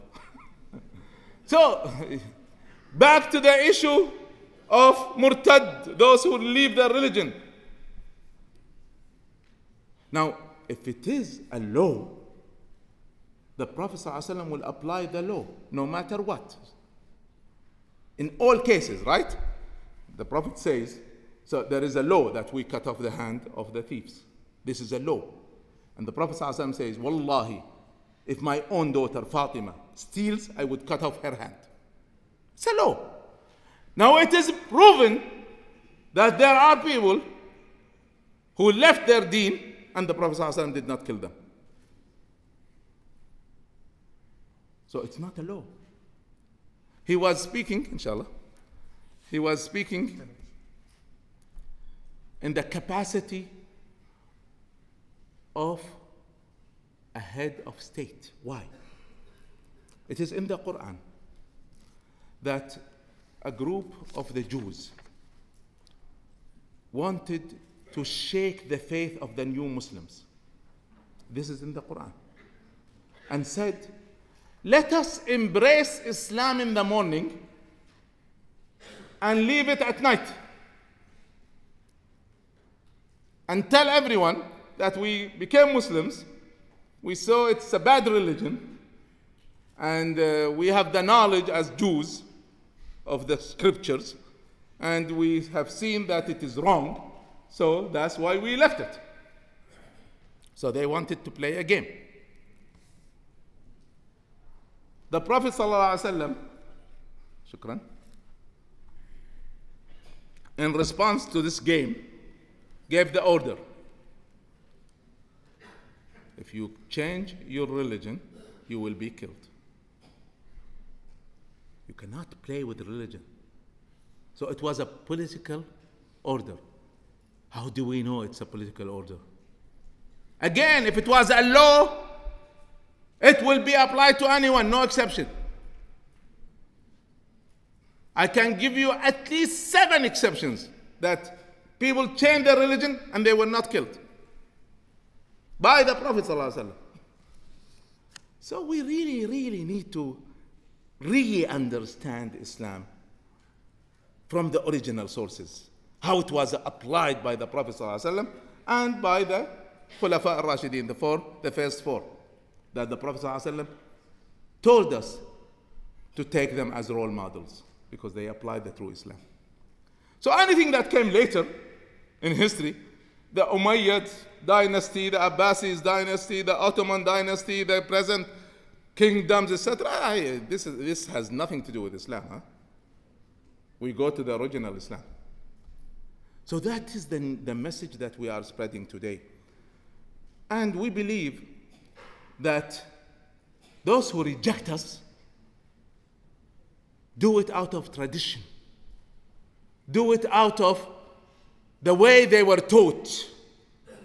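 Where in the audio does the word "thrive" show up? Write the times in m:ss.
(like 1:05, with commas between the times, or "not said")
not said.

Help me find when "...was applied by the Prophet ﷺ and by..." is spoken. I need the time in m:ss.
2:36.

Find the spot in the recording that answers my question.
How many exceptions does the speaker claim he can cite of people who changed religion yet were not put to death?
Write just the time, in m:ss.
2:19.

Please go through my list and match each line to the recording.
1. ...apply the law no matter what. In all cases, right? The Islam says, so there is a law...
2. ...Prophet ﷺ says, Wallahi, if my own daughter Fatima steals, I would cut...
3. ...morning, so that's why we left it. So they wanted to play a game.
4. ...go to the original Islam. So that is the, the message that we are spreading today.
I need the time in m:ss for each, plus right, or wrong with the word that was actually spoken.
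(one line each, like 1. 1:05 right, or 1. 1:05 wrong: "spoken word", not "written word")
1. 0:14 wrong: "Prophet", not "Islam"
2. 0:26 right
3. 1:36 wrong: "wrong", not "morning"
4. 3:03 right.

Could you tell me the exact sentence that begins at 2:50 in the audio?
So anything that came later in history, the Umayyad dynasty, the Abbasid dynasty, the Ottoman dynasty, the present kingdoms, etc.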